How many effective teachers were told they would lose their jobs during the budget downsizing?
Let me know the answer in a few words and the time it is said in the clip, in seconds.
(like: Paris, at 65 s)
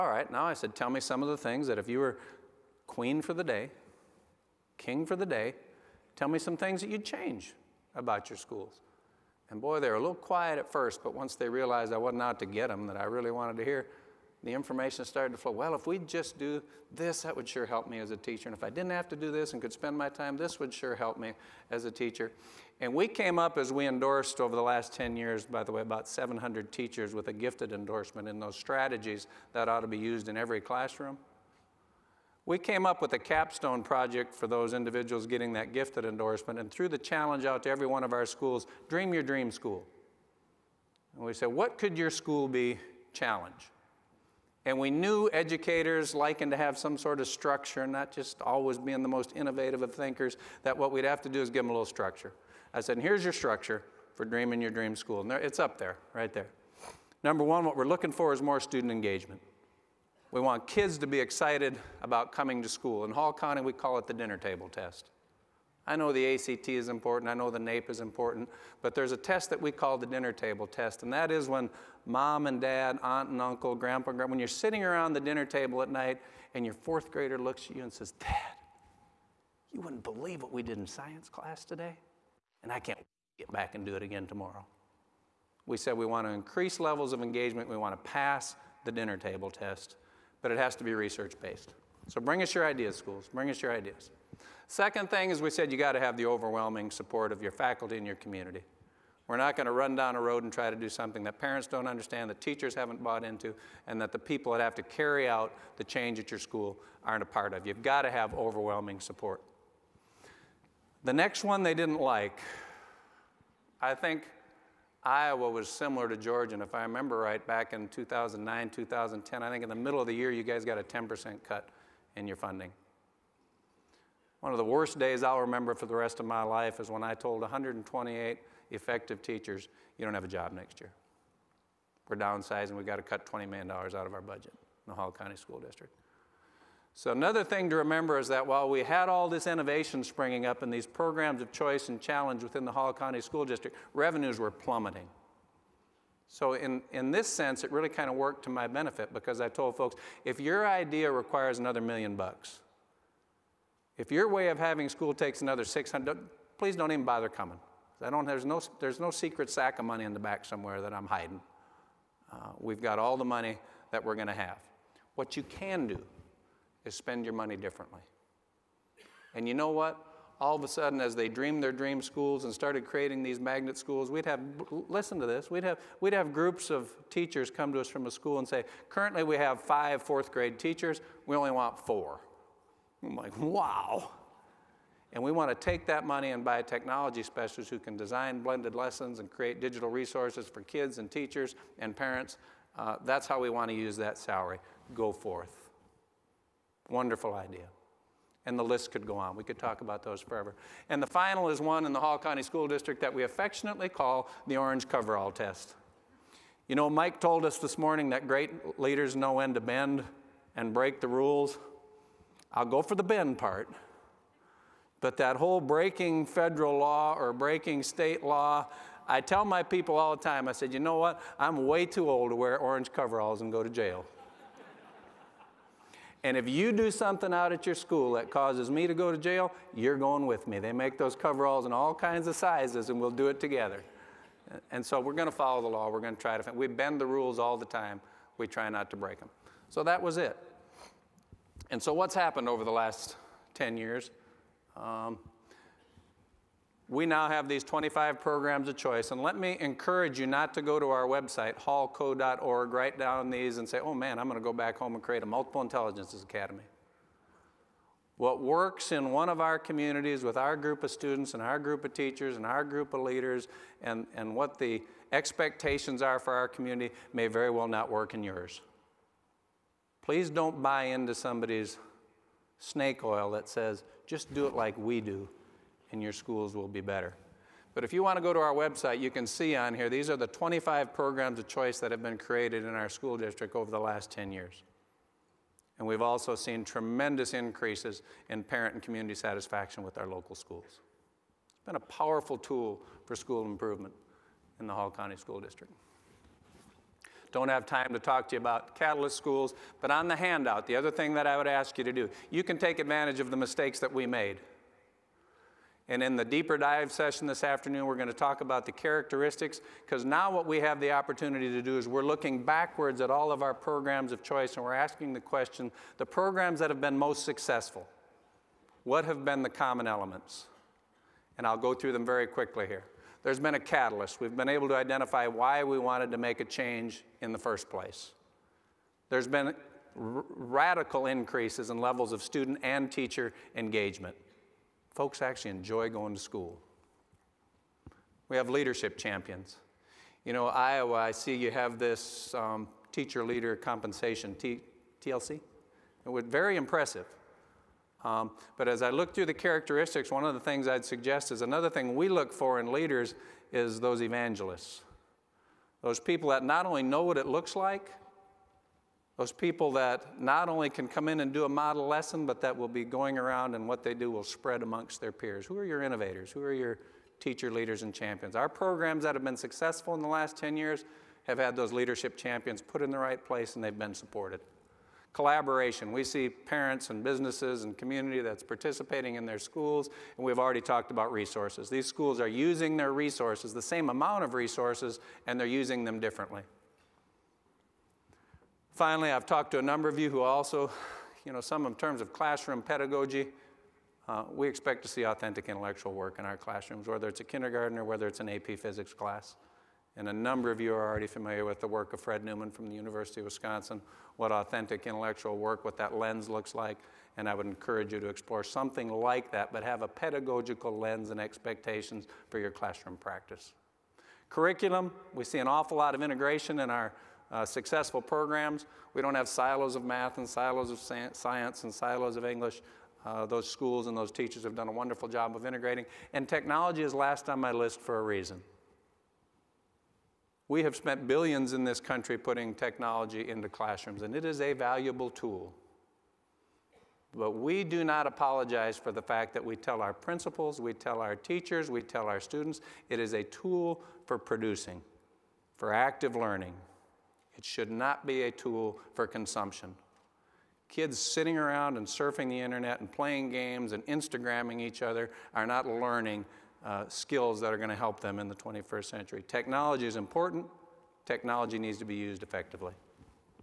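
128, at 127 s.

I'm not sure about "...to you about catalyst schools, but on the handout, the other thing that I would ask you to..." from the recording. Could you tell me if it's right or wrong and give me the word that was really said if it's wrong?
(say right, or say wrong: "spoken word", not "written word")
right.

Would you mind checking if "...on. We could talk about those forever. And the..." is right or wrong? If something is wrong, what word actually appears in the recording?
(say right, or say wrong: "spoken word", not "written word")
right.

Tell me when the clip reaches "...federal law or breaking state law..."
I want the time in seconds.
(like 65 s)
216 s.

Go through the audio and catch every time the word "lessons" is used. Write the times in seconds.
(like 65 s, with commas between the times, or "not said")
188 s, 361 s.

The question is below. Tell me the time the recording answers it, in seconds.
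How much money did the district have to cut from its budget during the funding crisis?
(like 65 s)
133 s.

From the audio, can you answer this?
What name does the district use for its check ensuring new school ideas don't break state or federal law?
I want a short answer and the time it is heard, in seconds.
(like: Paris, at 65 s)
orange coverall test, at 204 s.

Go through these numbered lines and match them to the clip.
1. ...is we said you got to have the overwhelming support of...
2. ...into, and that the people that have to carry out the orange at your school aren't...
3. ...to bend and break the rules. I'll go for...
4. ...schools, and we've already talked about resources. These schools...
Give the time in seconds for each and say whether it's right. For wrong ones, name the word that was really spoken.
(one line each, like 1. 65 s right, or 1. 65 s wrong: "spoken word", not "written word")
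1. 95 s right
2. 103 s wrong: "change", not "orange"
3. 209 s right
4. 379 s right.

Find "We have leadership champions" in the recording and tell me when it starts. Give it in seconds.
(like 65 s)
338 s.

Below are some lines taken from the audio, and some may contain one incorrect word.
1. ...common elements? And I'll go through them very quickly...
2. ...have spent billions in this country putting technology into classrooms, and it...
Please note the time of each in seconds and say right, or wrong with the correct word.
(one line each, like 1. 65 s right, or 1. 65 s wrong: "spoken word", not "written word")
1. 319 s right
2. 430 s right.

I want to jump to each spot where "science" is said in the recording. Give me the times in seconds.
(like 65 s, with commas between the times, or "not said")
80 s, 420 s.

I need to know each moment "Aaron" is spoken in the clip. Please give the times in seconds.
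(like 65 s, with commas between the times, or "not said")
not said.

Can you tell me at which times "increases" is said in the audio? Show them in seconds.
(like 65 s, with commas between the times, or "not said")
86 s, 287 s, 331 s.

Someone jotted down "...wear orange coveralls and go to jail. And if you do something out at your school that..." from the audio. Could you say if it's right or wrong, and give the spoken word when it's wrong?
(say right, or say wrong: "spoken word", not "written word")
right.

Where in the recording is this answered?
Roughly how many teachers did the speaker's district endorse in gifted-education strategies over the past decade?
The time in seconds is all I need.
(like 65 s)
25 s.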